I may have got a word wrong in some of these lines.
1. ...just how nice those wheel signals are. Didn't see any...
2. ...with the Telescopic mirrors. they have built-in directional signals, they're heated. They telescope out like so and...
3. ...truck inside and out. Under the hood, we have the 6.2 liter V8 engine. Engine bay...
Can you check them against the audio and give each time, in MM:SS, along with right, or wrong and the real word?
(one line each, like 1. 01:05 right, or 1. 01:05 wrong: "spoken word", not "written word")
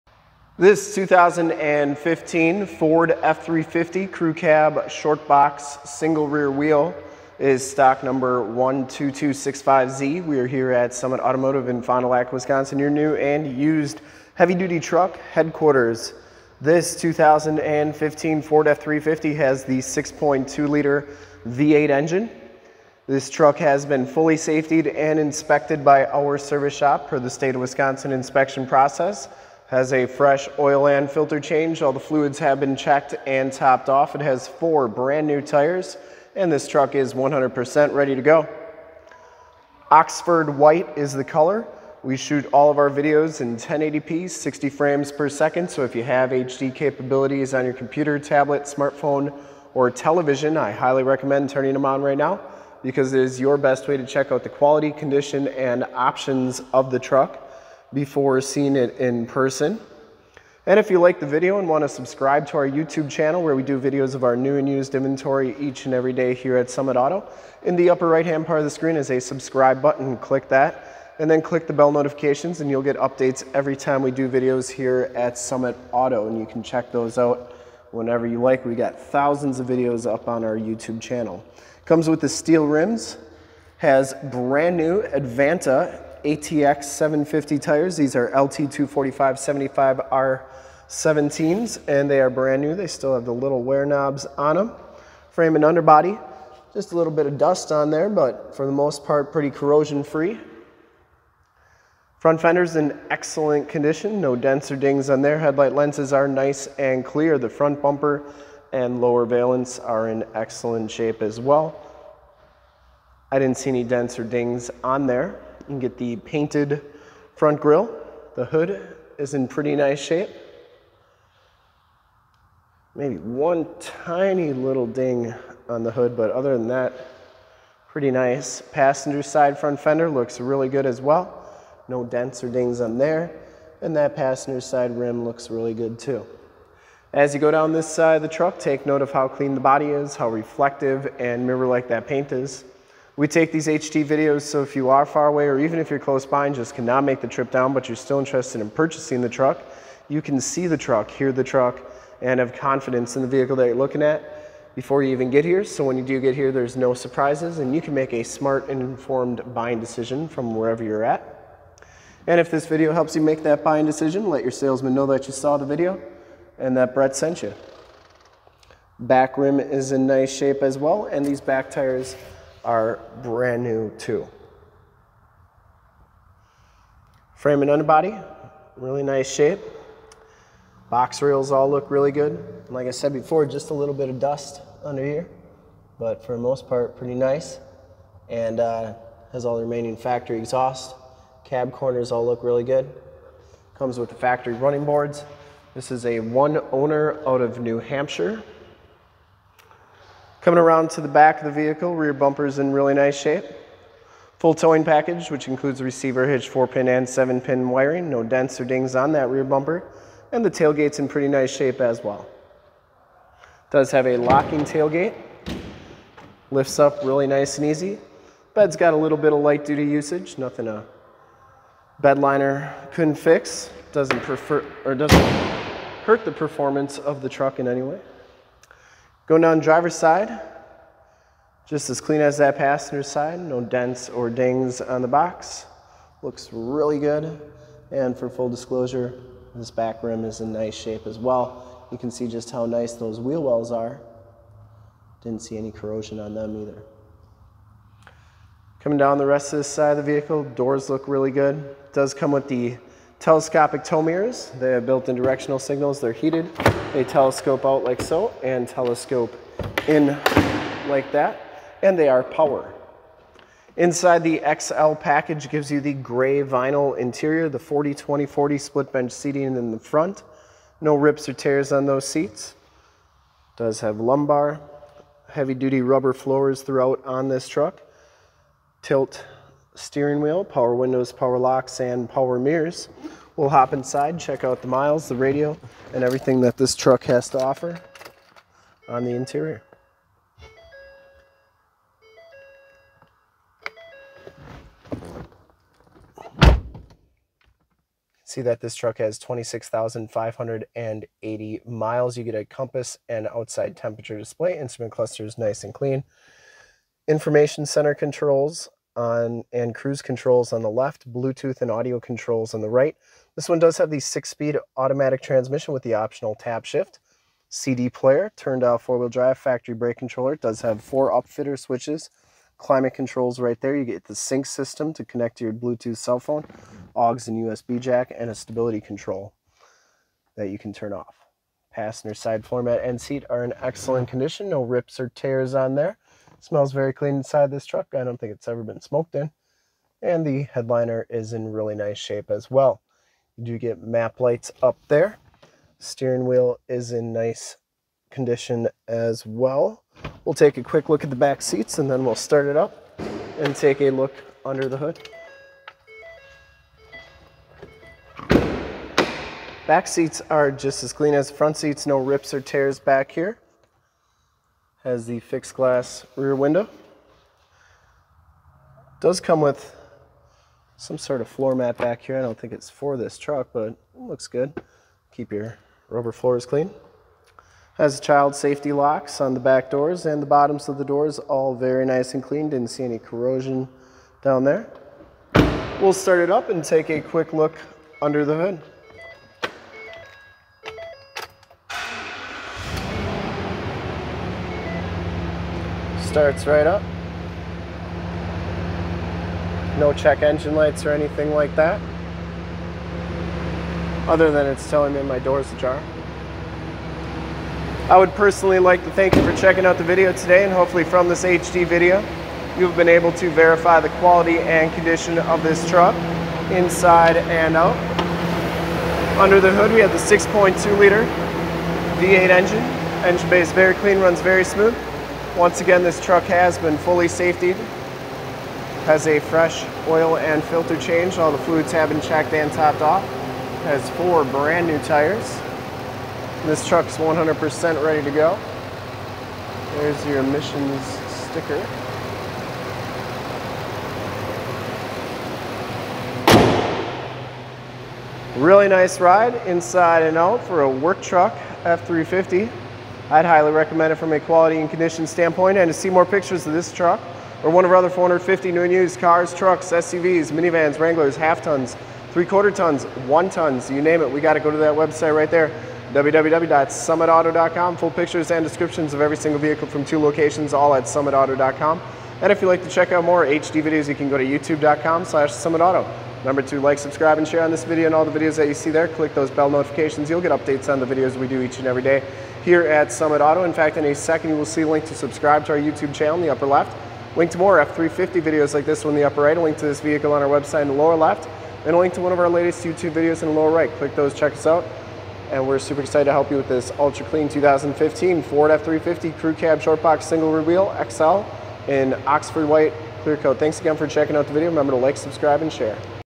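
1. 04:02 wrong: "wells", not "signals"
2. 04:12 right
3. 06:55 right.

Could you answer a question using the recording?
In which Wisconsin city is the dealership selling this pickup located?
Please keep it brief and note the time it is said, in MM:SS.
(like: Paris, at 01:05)
Fond du Lac, at 00:11.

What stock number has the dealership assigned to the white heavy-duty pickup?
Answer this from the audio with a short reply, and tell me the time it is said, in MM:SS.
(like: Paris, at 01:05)
12265Z, at 00:08.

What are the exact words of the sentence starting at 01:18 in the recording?
We got thousands of videos up on our YouTube channel.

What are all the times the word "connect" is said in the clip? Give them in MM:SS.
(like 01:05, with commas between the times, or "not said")
05:25.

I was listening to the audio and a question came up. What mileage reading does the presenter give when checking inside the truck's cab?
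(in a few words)
26,580 miles.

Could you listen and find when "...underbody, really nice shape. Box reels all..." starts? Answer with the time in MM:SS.
02:57.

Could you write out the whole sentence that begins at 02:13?
And that passenger side rim looks really good too.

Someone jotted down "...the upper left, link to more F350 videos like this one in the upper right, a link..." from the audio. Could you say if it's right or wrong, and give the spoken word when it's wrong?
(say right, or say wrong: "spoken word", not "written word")
right.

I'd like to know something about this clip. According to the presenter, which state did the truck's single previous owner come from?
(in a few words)
New Hampshire.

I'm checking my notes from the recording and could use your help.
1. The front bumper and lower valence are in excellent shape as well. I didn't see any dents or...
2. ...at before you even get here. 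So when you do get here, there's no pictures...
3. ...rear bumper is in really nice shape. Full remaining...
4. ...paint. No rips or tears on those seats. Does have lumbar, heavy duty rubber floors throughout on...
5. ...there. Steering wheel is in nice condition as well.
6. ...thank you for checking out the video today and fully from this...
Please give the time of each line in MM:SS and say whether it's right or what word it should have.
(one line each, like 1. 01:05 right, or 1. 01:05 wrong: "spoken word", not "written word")
1. 01:47 right
2. 02:34 wrong: "surprises", not "pictures"
3. 03:21 wrong: "towing", not "remaining"
4. 04:29 wrong: "front", not "paint"
5. 05:44 right
6. 06:48 wrong: "hopefully", not "fully".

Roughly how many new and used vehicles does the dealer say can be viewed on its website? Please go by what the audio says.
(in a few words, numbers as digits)
450.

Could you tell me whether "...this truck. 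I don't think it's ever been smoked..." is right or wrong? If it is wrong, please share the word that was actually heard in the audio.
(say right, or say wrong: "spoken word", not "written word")
right.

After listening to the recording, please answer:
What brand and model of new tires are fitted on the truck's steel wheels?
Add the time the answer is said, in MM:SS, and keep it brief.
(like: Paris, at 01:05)
Advanta ATX 750, at 01:25.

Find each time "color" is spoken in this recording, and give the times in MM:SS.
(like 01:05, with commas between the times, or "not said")
00:41.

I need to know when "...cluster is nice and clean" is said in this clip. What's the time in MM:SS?
05:04.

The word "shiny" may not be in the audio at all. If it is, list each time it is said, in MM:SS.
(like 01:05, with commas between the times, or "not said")
not said.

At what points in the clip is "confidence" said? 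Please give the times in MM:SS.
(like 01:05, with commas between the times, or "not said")
02:32.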